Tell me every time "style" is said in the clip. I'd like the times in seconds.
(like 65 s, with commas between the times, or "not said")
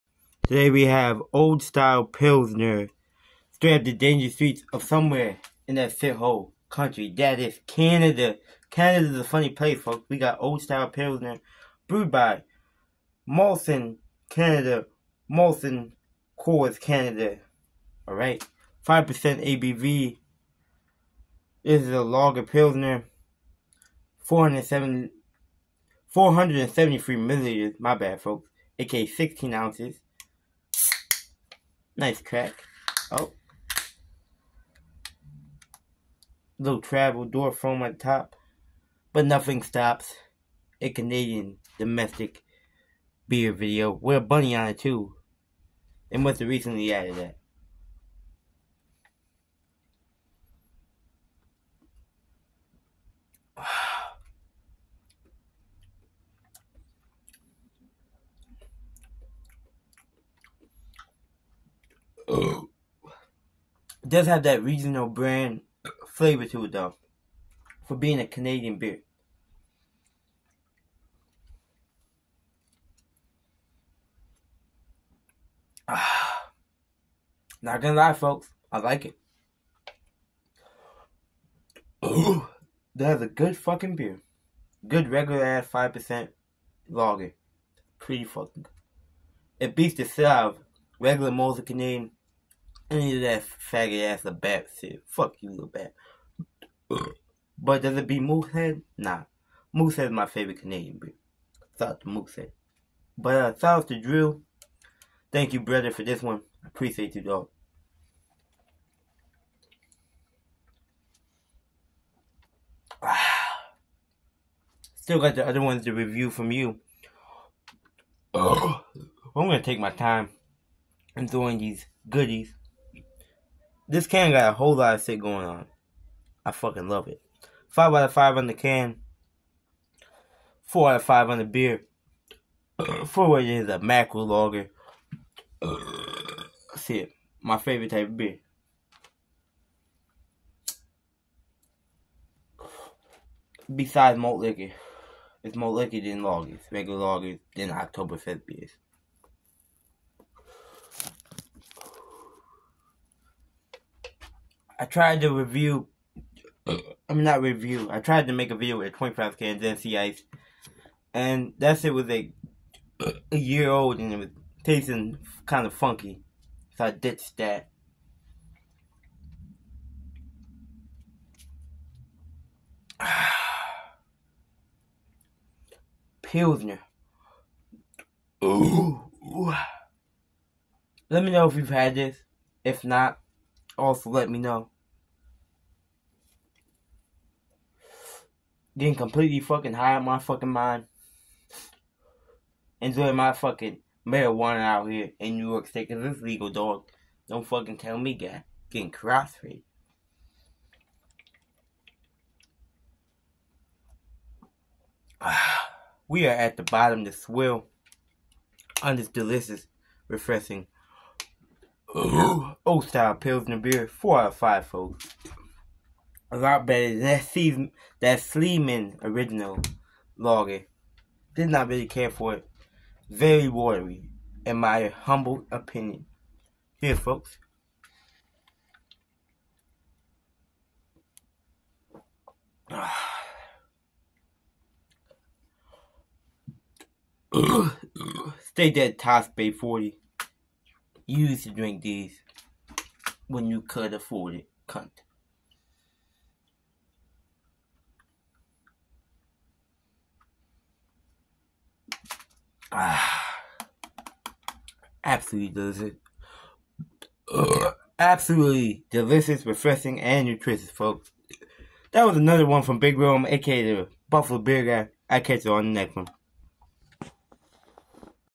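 1 s, 10 s, 212 s.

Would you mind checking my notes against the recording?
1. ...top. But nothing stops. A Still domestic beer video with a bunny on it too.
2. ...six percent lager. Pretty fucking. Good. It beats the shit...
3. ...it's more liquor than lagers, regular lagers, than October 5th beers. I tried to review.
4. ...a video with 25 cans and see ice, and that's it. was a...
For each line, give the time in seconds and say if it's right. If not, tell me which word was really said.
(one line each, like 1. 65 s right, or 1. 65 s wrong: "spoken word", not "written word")
1. 37 s wrong: "Canadian", not "Still"
2. 85 s wrong: "five", not "six"
3. 145 s right
4. 158 s right.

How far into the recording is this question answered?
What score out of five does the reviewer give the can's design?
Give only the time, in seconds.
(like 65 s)
127 s.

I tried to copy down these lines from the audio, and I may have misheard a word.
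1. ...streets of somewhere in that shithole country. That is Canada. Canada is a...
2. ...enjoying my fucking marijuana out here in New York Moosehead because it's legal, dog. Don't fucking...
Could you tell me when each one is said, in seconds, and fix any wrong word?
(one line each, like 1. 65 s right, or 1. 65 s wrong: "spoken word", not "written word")
1. 4 s right
2. 192 s wrong: "State", not "Moosehead".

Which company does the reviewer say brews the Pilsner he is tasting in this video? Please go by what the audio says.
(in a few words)
Molson Canada.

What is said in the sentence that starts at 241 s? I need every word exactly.
You used to drink these when you could afford it, cunt.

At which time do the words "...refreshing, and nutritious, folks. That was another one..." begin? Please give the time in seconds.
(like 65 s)
259 s.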